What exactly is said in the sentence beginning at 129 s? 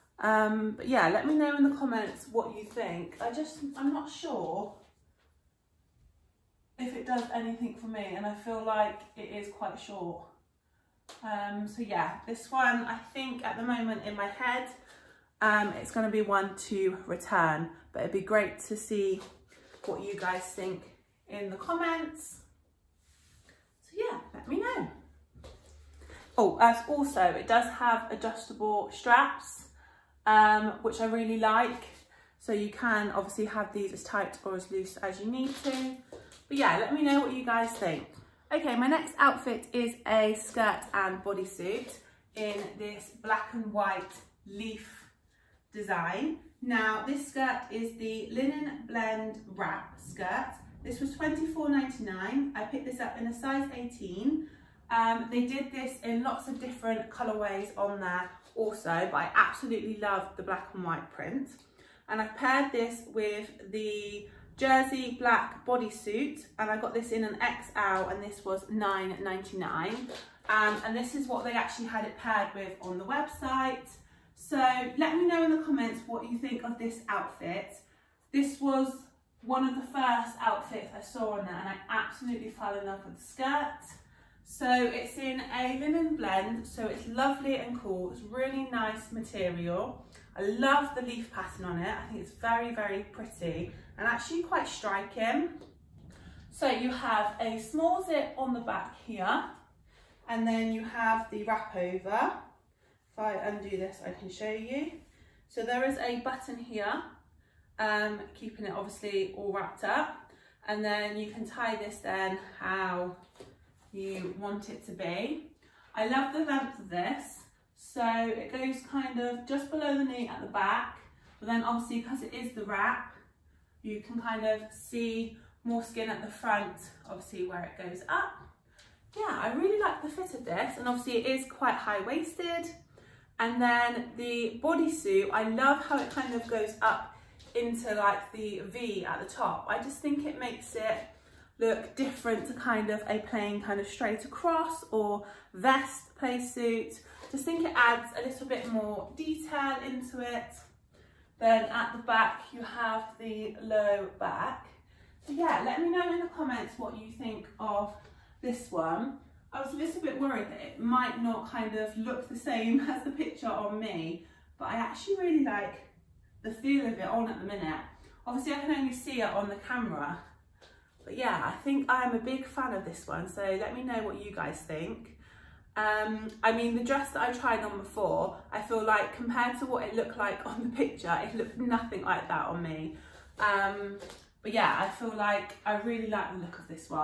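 Yeah, I really like the fit of this, and obviously it is quite high-waisted.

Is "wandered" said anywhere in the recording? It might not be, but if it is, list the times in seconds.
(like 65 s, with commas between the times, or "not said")
not said.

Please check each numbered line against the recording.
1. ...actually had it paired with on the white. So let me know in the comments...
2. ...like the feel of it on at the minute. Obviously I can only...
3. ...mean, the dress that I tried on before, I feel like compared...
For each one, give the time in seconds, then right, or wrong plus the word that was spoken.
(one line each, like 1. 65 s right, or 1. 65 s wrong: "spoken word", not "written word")
1. 71 s wrong: "website", not "white"
2. 165 s right
3. 176 s right.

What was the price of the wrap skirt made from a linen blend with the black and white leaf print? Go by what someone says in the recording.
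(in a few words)
$24.99.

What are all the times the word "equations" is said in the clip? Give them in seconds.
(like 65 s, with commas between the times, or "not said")
not said.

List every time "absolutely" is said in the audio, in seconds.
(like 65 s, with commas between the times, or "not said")
59 s, 81 s.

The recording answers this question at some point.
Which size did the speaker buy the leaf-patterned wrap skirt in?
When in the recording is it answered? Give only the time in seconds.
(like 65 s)
53 s.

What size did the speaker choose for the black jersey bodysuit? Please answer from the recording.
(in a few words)
XL.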